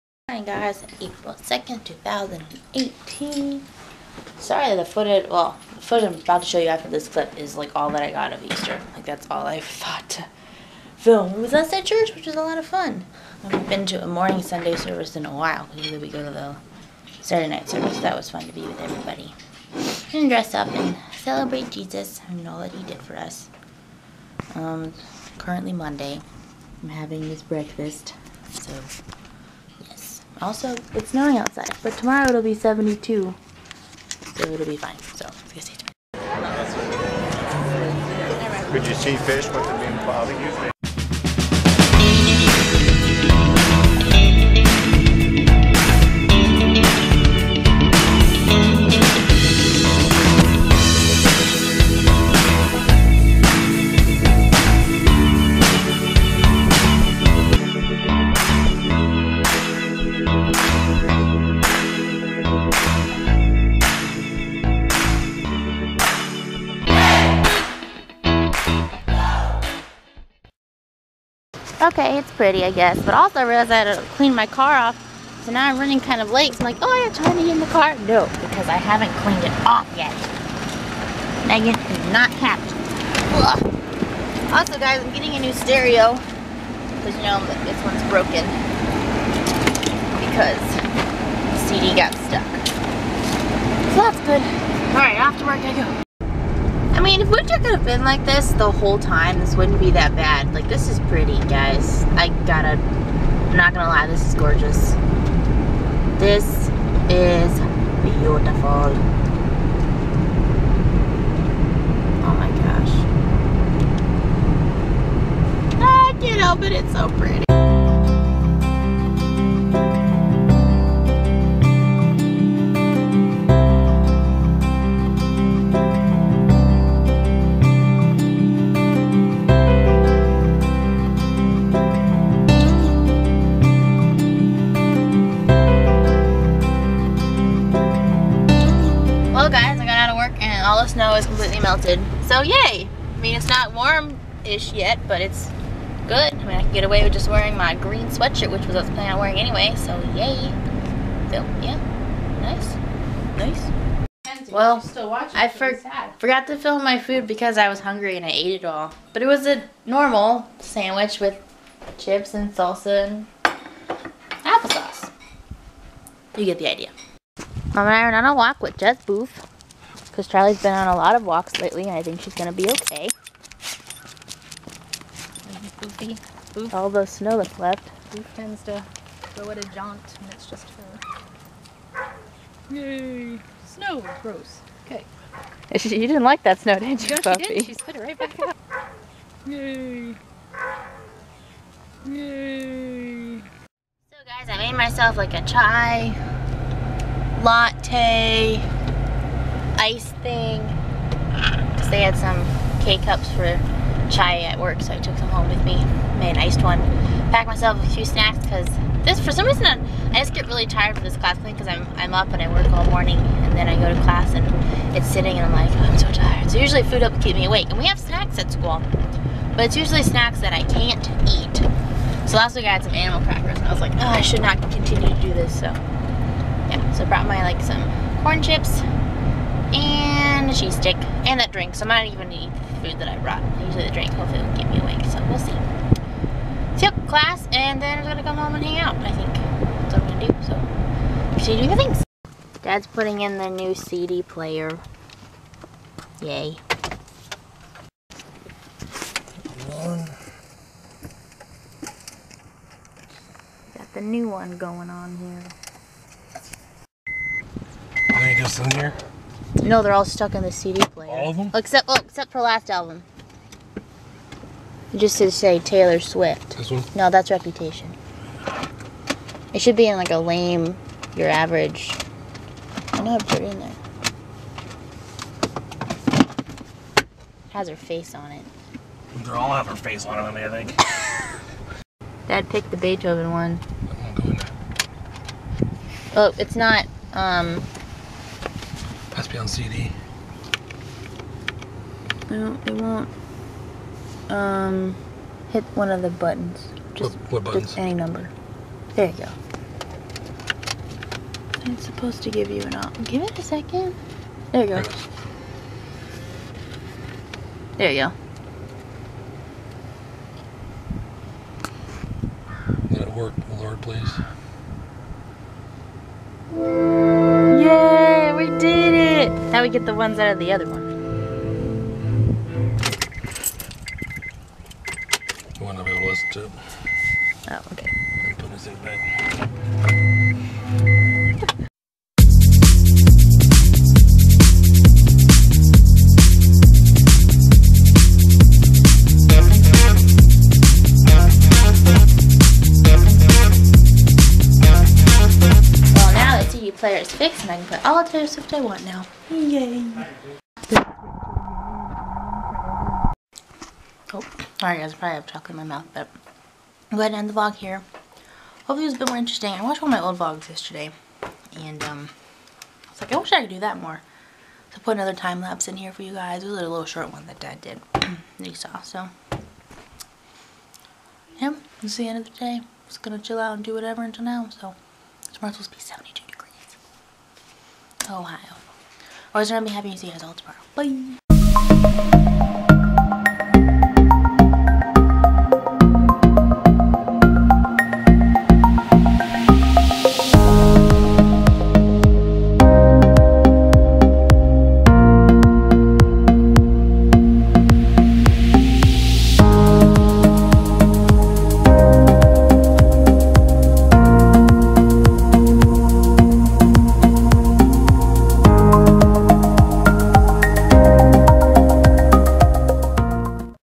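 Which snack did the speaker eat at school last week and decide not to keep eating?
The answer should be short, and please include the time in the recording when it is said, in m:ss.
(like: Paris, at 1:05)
animal crackers, at 3:42.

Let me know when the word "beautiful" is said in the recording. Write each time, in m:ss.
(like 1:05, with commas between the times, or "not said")
1:48.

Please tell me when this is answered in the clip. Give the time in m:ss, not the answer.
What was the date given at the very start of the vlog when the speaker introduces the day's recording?
0:01.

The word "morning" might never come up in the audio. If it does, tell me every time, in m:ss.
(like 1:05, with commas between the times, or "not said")
0:14, 3:32.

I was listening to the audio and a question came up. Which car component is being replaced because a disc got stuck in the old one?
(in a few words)
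stereo.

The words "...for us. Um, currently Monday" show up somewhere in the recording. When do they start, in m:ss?
0:23.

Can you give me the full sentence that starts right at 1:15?
So now I'm running kind of late.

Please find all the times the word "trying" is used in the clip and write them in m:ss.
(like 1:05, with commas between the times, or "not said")
1:17.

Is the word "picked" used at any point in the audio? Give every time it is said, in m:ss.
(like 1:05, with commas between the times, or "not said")
4:42.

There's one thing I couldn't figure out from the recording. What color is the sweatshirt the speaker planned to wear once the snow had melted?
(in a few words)
green.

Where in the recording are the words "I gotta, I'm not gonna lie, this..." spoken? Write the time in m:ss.
1:42.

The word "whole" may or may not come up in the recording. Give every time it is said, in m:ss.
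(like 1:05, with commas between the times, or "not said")
1:38.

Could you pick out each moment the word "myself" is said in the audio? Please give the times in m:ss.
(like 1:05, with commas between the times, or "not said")
3:14, 3:27.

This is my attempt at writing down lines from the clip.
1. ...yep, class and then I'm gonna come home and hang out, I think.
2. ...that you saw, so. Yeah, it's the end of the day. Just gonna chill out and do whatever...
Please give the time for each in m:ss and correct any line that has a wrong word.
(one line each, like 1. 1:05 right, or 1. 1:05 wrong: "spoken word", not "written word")
1. 3:56 right
2. 6:07 right.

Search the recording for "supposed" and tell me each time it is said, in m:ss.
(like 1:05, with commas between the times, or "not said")
5:01, 6:15.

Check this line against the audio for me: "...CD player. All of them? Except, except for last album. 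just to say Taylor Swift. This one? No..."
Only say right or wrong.
right.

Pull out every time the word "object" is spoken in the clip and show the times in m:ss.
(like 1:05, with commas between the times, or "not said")
not said.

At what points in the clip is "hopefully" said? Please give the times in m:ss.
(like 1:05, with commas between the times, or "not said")
3:54, 5:58.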